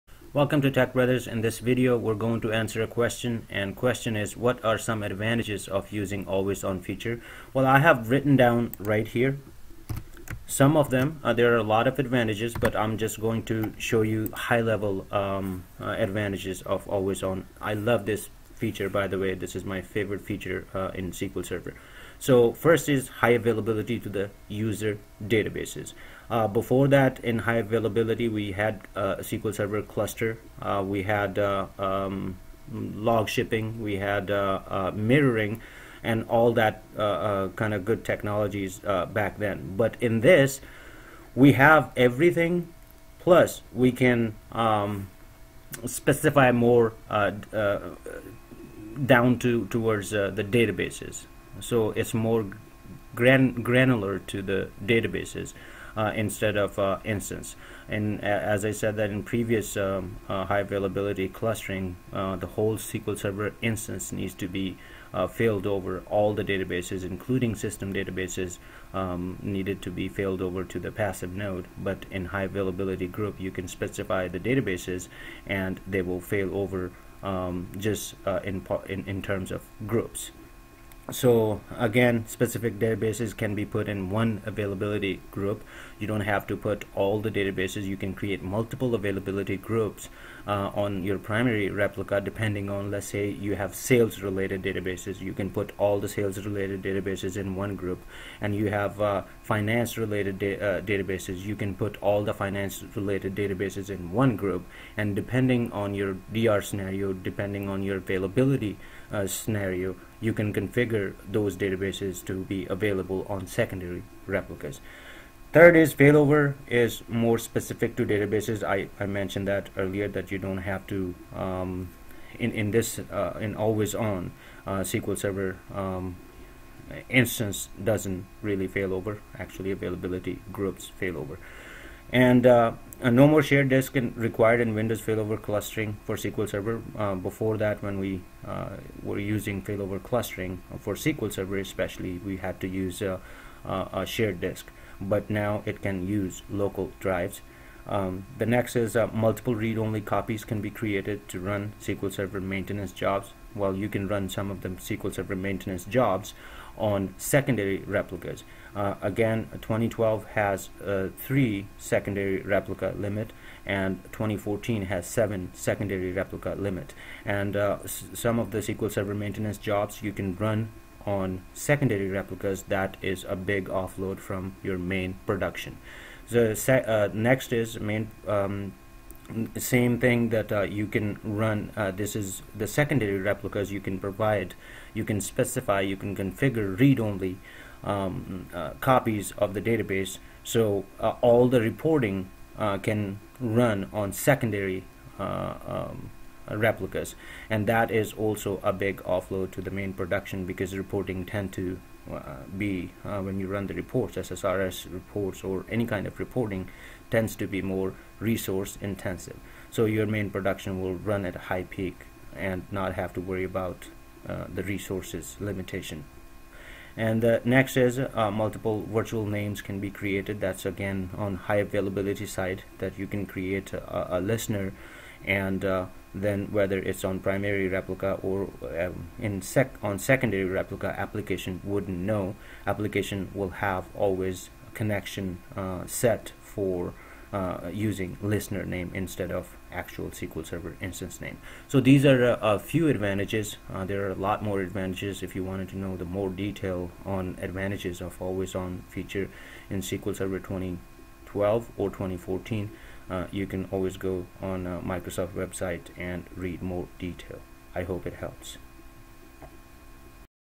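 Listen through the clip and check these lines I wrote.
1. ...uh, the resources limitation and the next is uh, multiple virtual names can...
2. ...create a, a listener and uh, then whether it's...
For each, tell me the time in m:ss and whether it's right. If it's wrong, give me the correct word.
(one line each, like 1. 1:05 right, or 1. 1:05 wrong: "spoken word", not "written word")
1. 3:34 right
2. 3:43 right.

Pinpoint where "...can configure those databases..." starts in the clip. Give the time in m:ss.
1:50.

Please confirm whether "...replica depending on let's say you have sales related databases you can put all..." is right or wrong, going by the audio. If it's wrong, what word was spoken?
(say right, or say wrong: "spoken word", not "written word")
right.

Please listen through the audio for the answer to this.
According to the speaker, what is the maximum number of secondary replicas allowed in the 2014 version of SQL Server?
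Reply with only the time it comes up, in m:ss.
2:45.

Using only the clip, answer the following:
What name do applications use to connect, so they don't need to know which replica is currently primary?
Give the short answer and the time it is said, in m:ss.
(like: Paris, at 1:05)
Listener name, at 3:58.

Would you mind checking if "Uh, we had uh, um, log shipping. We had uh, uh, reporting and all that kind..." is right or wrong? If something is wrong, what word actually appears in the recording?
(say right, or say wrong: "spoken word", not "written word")
wrong: "mirroring", not "reporting".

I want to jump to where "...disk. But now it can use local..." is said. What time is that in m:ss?
2:24.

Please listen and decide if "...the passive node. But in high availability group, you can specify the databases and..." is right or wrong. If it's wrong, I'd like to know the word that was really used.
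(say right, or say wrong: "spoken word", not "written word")
right.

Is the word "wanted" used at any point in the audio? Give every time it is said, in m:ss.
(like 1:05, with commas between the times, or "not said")
4:05.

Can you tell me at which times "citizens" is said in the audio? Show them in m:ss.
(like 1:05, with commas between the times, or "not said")
not said.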